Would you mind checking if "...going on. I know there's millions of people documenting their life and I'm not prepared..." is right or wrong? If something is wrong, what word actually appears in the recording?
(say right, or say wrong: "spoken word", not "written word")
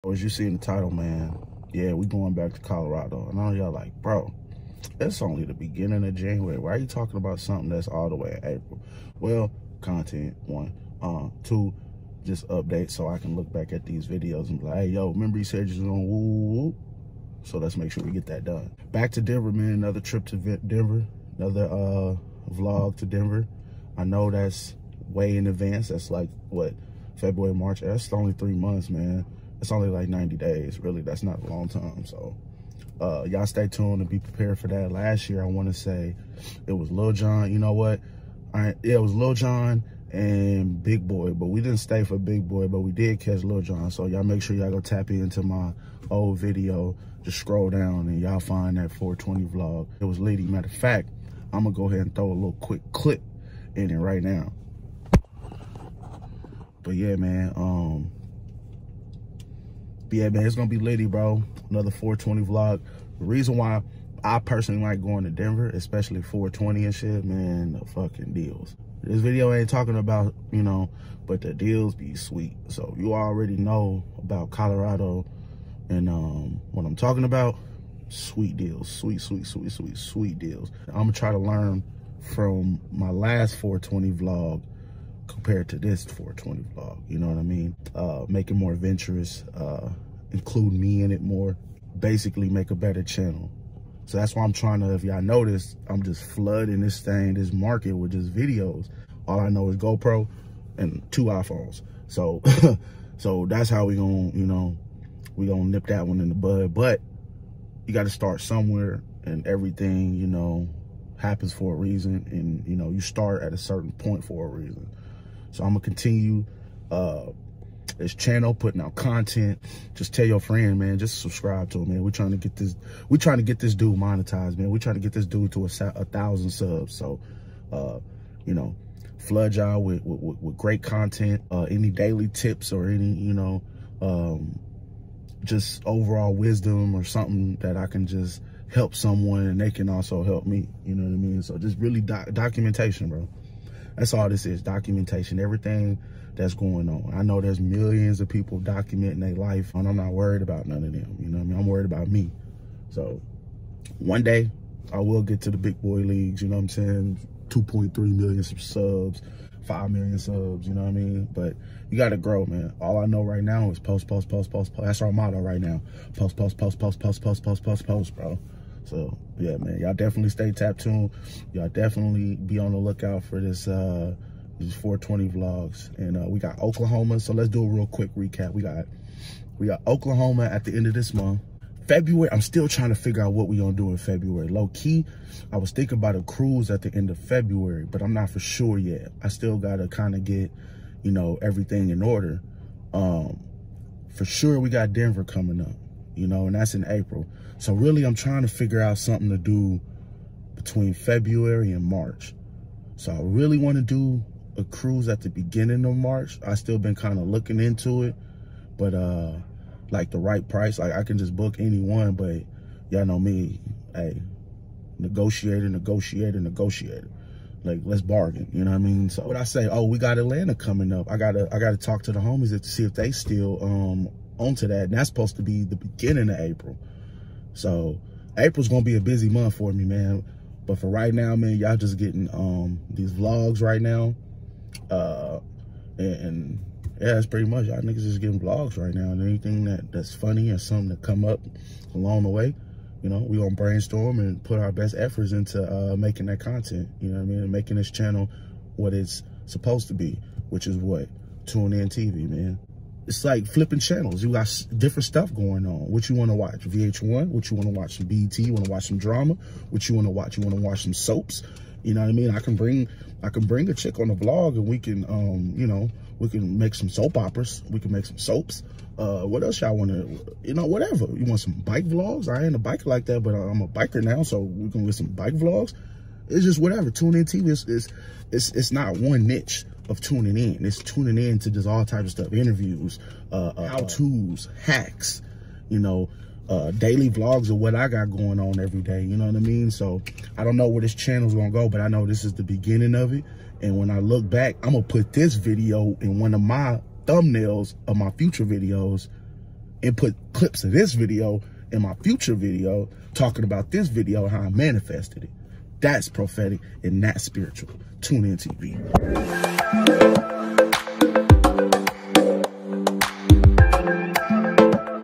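wrong: "worried", not "prepared".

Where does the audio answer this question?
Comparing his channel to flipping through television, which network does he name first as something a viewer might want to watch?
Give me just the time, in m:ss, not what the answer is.
4:16.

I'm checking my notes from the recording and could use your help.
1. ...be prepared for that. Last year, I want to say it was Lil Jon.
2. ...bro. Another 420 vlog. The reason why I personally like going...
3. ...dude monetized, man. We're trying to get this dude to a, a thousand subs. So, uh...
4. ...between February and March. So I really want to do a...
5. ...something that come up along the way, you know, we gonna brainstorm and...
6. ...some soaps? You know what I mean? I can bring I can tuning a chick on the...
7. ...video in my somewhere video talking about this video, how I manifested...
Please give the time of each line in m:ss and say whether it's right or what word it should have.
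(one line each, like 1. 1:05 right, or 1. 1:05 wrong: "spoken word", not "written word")
1. 0:34 right
2. 1:01 right
3. 2:03 right
4. 3:20 right
5. 4:00 right
6. 4:20 wrong: "bring", not "tuning"
7. 5:00 wrong: "future", not "somewhere".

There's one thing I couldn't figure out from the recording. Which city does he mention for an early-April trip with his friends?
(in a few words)
Atlanta.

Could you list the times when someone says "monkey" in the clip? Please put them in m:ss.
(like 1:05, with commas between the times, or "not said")
not said.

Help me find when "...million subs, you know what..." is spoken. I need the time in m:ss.
2:39.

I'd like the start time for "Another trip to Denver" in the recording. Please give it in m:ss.
0:19.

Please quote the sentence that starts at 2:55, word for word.
And uh, we got Oklahoma, so let's do a real quick recap.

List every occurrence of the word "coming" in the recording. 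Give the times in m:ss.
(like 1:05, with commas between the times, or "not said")
3:15, 3:40.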